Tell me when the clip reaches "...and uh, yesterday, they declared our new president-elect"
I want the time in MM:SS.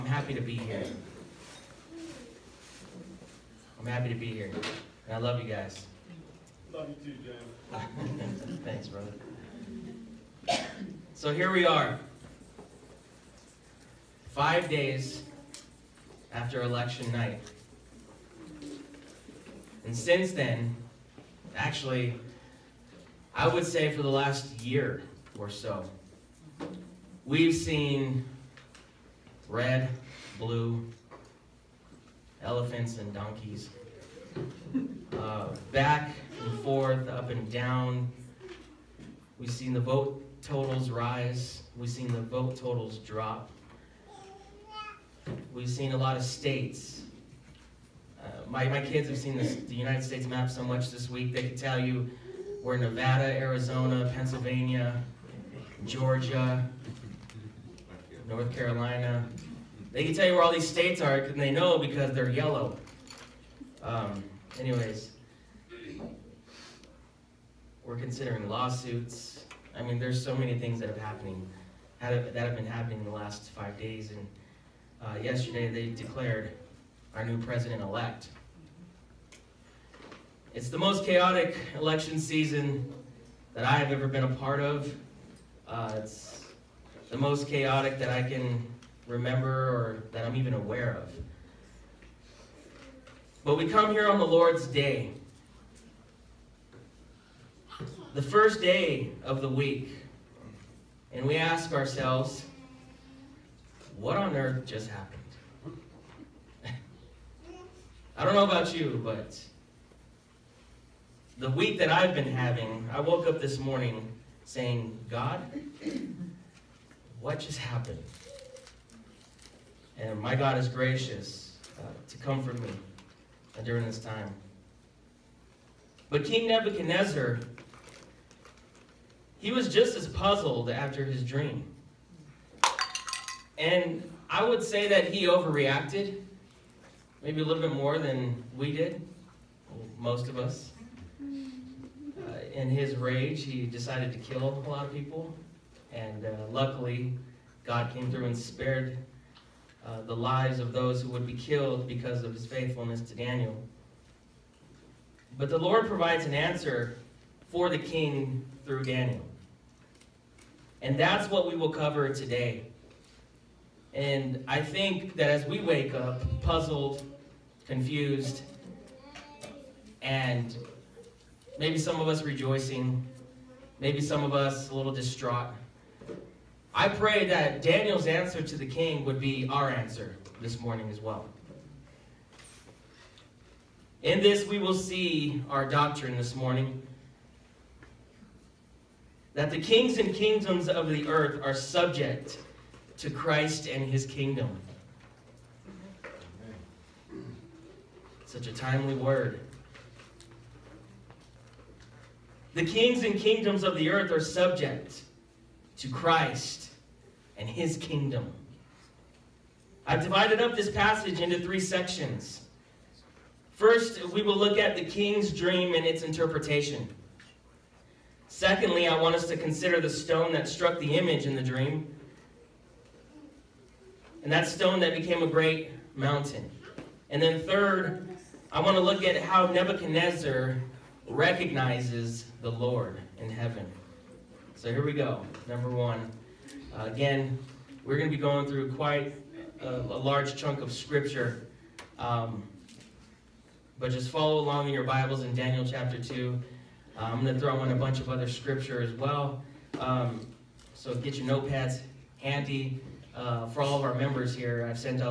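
01:14.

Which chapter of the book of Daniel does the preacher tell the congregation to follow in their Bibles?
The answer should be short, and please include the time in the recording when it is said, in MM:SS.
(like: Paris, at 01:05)
Chapter 2, at 04:05.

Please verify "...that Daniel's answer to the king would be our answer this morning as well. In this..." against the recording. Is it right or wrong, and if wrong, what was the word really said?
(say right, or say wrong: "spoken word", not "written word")
right.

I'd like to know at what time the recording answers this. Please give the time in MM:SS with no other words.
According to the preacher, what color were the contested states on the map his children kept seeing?
01:02.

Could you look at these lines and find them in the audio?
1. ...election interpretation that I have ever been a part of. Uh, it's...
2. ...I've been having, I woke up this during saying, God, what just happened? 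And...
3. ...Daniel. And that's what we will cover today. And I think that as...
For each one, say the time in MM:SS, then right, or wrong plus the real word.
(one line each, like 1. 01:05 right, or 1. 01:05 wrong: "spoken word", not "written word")
1. 01:21 wrong: "season", not "interpretation"
2. 01:51 wrong: "morning", not "during"
3. 02:38 right.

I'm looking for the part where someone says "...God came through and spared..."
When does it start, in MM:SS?
02:27.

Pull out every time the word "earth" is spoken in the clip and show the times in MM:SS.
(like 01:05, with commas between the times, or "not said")
01:44, 03:11, 03:23.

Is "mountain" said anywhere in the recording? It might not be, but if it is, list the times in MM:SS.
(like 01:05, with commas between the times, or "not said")
03:45.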